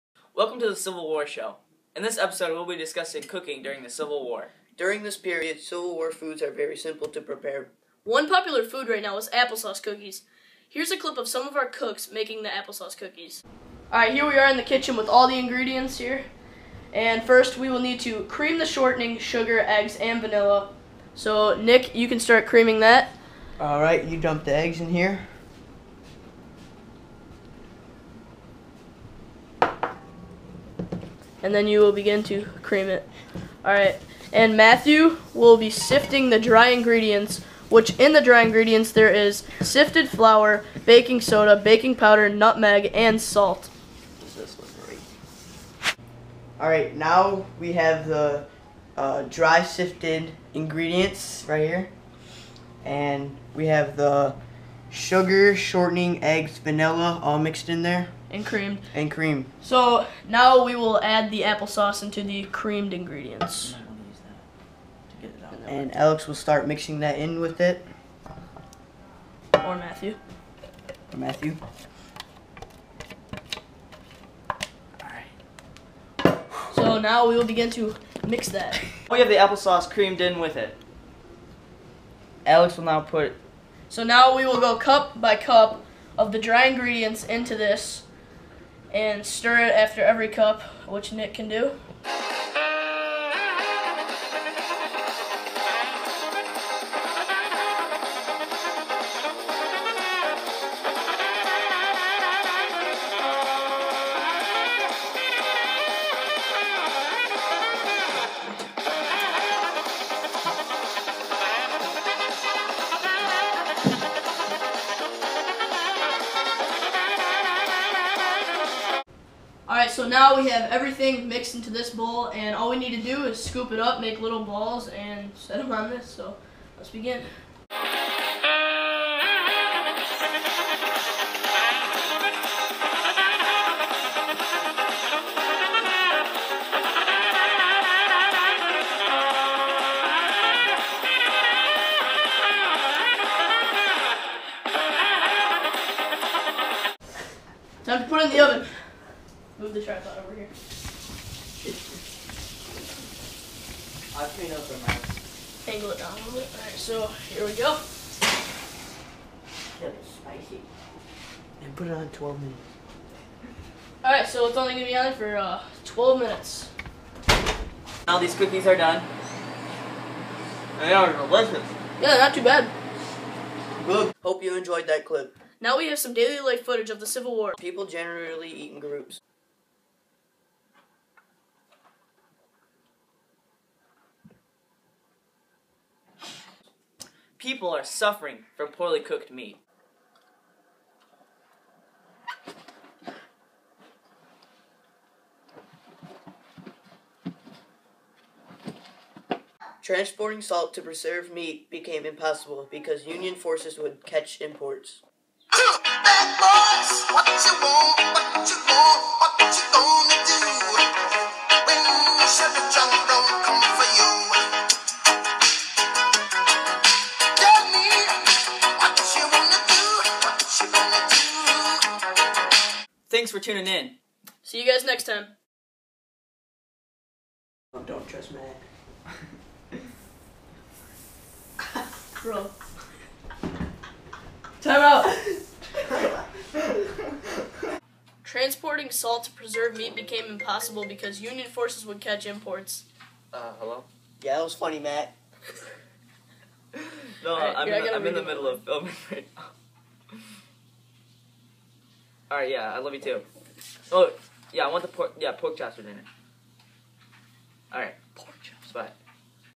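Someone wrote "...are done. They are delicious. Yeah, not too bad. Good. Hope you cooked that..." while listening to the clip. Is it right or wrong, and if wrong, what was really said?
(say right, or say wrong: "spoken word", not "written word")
wrong: "enjoyed", not "cooked".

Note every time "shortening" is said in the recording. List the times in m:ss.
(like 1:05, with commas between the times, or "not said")
0:18, 0:55.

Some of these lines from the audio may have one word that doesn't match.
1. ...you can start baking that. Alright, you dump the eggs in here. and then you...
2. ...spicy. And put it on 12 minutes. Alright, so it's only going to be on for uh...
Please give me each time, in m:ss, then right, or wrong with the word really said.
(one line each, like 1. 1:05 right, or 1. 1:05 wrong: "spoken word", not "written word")
1. 0:21 wrong: "creaming", not "baking"
2. 2:40 right.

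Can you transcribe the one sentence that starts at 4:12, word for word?
All right, yeah, I love you too.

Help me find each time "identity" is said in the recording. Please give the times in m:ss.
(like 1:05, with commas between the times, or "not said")
not said.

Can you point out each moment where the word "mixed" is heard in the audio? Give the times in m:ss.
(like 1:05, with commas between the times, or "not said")
0:57, 2:01.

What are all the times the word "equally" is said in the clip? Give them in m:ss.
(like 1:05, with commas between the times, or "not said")
not said.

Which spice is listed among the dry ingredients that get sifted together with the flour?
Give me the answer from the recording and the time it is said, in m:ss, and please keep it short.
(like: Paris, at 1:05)
Nutmeg, at 0:42.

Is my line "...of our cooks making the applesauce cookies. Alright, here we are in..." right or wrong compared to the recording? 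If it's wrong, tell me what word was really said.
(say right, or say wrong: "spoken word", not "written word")
right.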